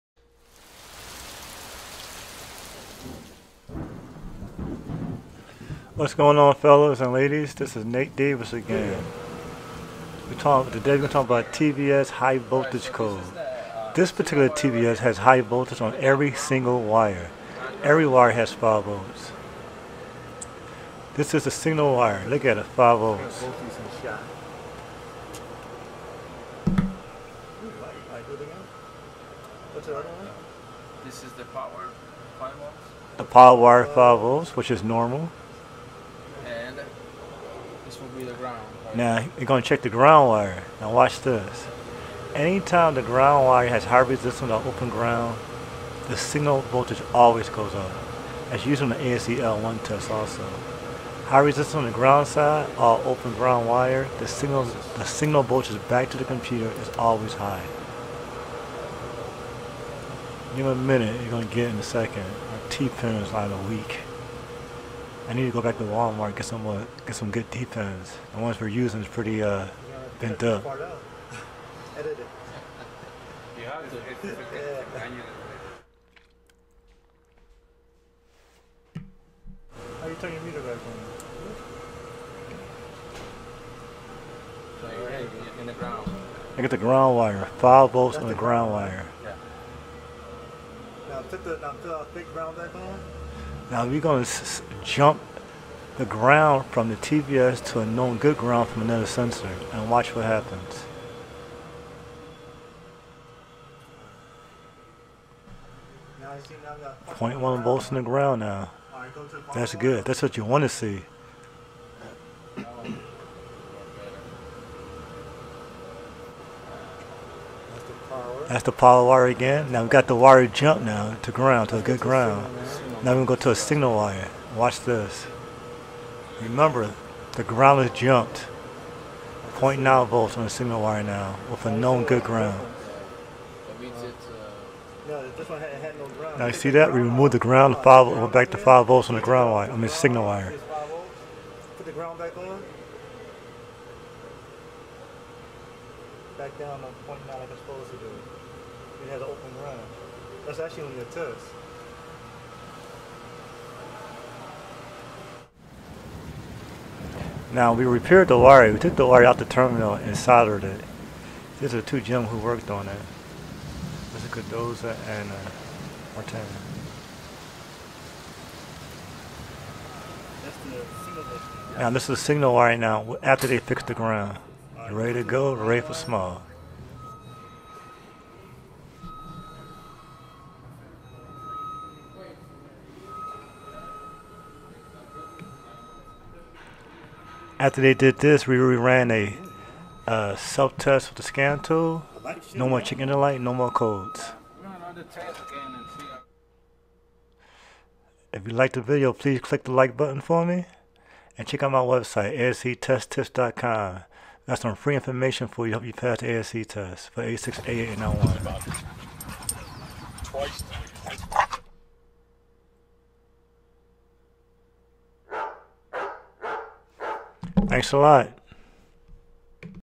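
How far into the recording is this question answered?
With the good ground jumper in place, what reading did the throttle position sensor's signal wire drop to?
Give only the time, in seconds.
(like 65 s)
129 s.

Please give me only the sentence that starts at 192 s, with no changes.
No more chicken delight, no more codes.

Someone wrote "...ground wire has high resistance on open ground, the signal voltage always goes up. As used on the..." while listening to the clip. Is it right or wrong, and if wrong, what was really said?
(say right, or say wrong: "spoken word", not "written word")
right.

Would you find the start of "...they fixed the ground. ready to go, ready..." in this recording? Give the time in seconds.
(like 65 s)
173 s.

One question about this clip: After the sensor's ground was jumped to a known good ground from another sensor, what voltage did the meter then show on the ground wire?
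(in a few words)
0.1 volts.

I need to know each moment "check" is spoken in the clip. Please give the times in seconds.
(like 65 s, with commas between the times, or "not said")
39 s, 201 s.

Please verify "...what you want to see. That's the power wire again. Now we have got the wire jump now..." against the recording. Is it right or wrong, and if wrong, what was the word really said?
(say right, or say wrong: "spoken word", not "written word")
right.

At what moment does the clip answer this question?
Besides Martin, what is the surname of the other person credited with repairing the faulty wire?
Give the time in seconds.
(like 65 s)
164 s.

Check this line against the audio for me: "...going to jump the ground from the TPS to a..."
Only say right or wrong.
right.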